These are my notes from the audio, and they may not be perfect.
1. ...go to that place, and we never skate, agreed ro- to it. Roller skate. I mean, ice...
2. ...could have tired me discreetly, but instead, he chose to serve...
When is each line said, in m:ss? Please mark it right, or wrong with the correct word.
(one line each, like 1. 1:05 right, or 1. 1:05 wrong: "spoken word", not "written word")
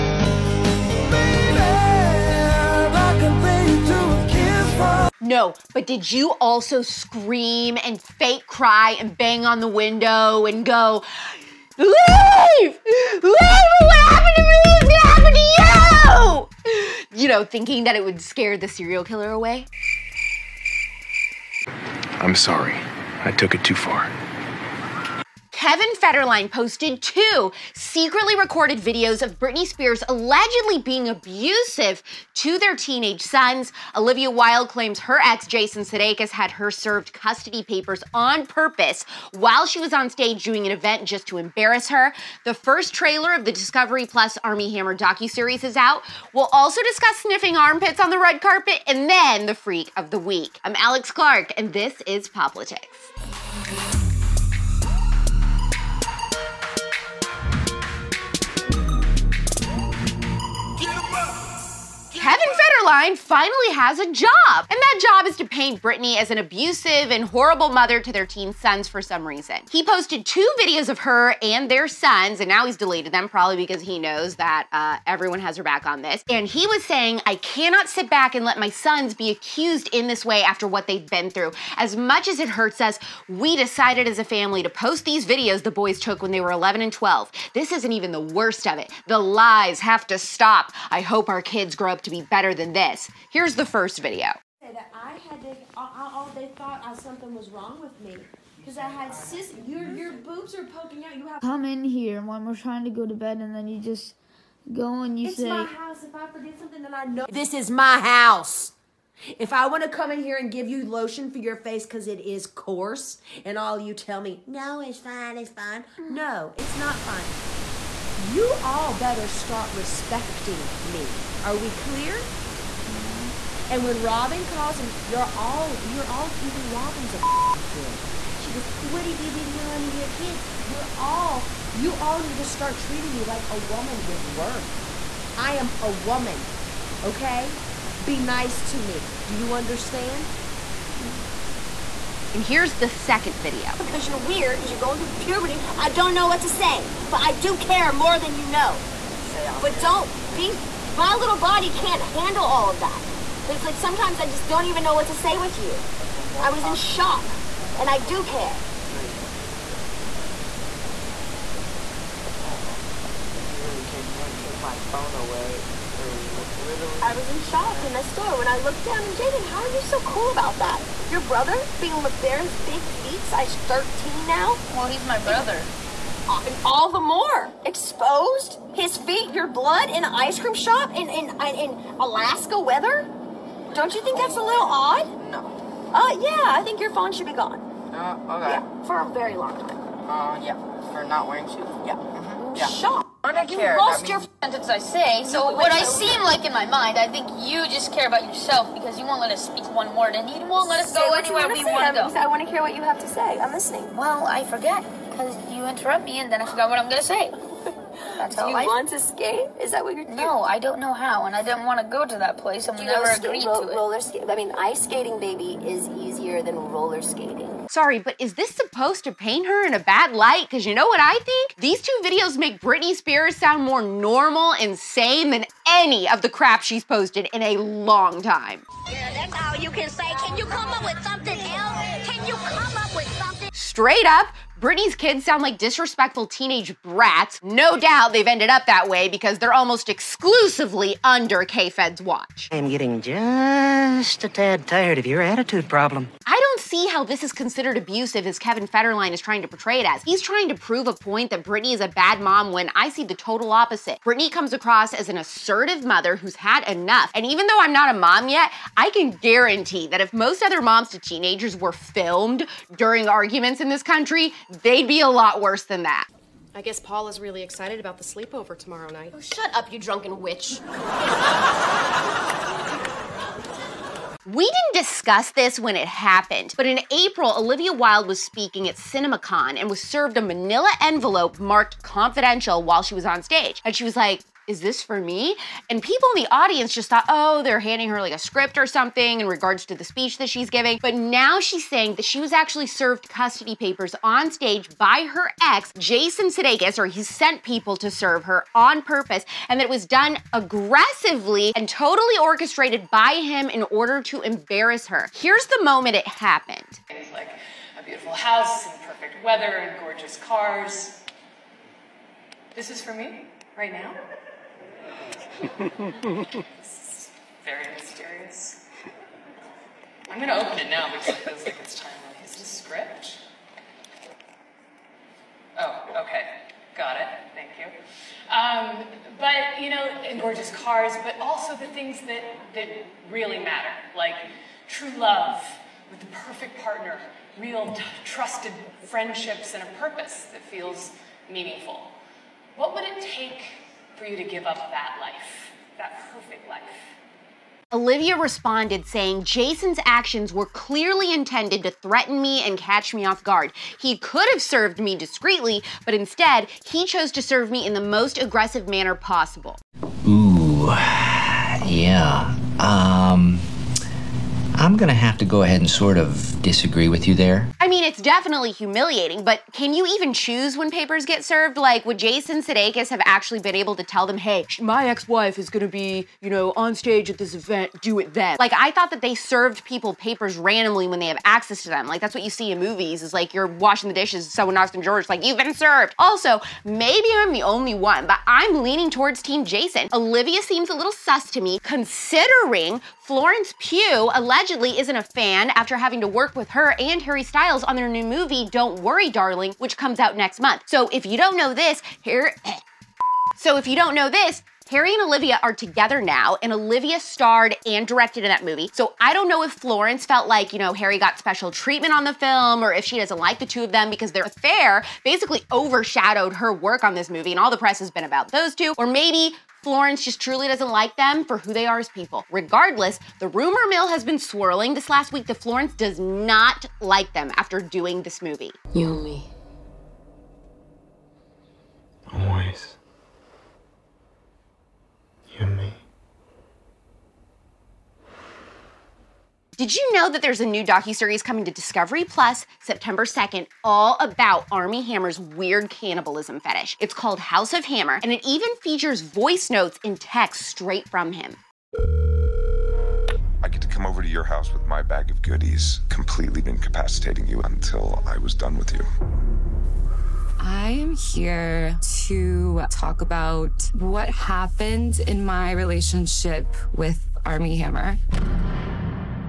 1. 3:31 right
2. 5:53 wrong: "served", not "tired".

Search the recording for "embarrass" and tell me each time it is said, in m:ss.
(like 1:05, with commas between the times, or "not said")
0:41, 5:04.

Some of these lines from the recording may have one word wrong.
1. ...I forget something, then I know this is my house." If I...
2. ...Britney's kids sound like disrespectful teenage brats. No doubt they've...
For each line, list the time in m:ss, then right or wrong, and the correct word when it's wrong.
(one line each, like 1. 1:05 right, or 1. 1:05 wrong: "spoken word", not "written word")
1. 1:46 right
2. 3:54 right.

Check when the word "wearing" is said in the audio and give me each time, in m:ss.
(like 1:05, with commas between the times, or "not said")
3:11.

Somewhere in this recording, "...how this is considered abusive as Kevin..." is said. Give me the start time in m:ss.
4:06.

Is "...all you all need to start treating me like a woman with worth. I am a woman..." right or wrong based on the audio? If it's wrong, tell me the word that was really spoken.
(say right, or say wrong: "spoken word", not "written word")
right.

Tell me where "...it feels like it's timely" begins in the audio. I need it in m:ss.
5:21.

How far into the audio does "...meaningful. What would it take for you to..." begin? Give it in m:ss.
5:41.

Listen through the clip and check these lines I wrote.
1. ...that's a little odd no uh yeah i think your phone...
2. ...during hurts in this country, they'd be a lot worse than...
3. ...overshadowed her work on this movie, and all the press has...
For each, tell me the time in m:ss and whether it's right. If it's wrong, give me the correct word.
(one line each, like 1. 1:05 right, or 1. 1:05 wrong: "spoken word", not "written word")
1. 3:04 right
2. 4:22 wrong: "arguments", not "hurts"
3. 6:55 right.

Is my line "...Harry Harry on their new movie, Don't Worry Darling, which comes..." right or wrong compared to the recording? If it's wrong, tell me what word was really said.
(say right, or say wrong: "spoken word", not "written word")
wrong: "Styles", not "Harry".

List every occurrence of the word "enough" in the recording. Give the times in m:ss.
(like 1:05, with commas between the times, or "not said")
4:16.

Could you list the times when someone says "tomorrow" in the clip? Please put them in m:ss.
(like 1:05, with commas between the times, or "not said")
4:28.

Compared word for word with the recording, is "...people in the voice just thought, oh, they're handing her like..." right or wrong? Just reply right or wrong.
wrong.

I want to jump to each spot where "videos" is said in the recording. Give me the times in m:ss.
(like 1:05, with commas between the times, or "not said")
0:28, 1:10, 1:25, 1:34, 2:23, 3:42.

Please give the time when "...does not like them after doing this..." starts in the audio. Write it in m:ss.
7:05.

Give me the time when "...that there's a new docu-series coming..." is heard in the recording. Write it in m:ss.
7:20.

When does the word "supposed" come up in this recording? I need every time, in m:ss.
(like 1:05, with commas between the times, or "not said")
3:38.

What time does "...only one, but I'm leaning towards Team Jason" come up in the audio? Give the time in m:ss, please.
6:27.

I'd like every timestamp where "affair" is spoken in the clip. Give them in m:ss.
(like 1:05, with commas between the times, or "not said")
6:54.